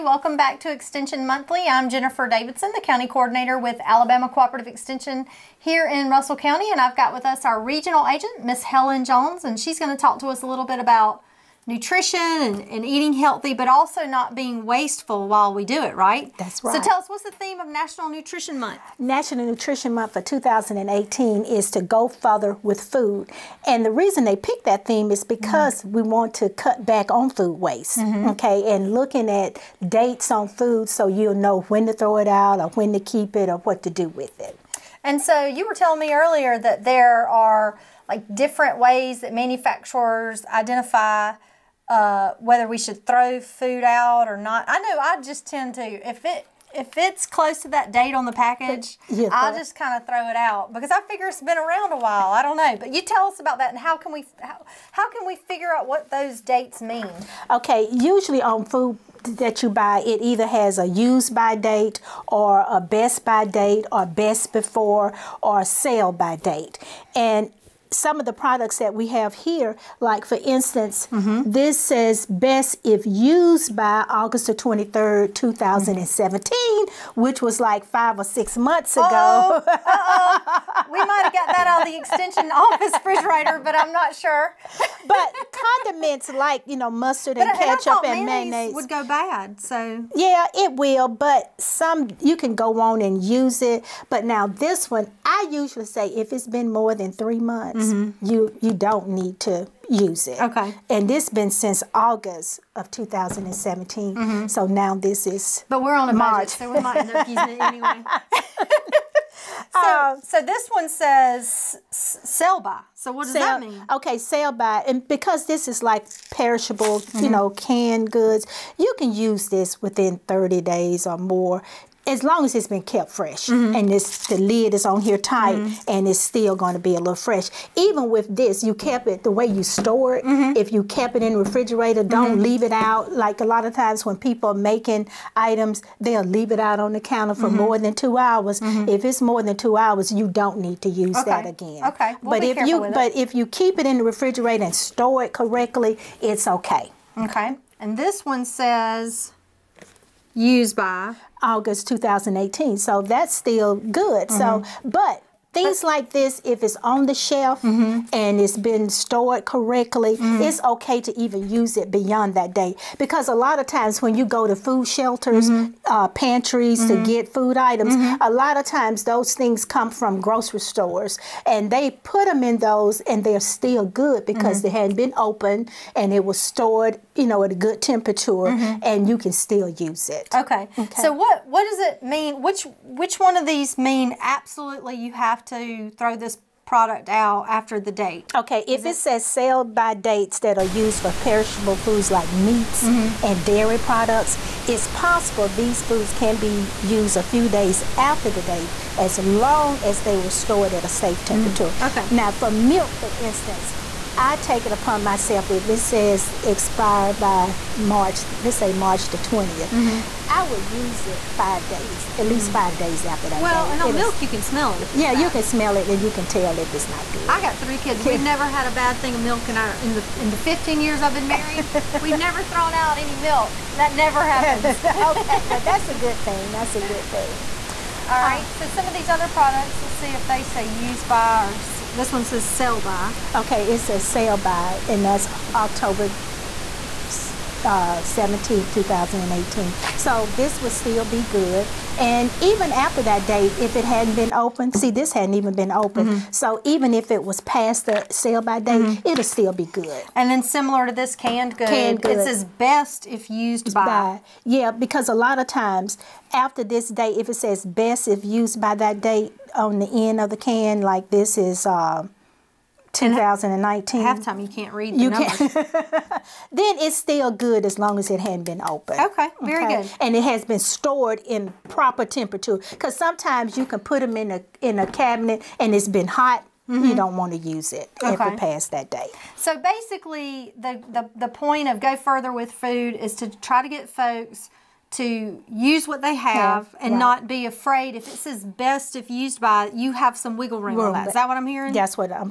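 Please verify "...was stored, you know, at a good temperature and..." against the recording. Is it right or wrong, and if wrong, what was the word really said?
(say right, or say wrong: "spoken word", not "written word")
right.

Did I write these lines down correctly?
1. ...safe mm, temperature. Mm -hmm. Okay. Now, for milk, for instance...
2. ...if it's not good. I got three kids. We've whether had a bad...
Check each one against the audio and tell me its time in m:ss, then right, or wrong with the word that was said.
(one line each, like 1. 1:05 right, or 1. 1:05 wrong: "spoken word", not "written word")
1. 3:20 right
2. 3:36 wrong: "never", not "whether".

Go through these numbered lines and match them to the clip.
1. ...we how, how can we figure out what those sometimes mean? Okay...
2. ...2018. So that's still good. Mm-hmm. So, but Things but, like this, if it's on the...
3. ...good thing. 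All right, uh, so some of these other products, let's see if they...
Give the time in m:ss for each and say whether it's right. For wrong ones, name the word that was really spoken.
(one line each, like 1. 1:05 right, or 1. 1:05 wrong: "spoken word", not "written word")
1. 0:54 wrong: "dates", not "sometimes"
2. 2:31 right
3. 3:46 right.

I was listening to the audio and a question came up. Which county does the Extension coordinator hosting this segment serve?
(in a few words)
Russell County.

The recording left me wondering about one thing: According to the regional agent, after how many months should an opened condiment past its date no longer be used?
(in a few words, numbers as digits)
3 months.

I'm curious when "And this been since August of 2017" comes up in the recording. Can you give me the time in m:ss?
1:40.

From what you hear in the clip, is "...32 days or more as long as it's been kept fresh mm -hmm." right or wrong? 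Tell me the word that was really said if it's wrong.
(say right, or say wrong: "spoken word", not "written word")
wrong: "30", not "32".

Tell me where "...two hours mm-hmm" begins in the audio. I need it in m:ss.
2:17.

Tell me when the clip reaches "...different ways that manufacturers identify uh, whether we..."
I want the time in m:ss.
0:38.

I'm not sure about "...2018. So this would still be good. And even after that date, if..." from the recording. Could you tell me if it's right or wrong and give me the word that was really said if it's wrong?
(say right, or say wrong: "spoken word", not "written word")
right.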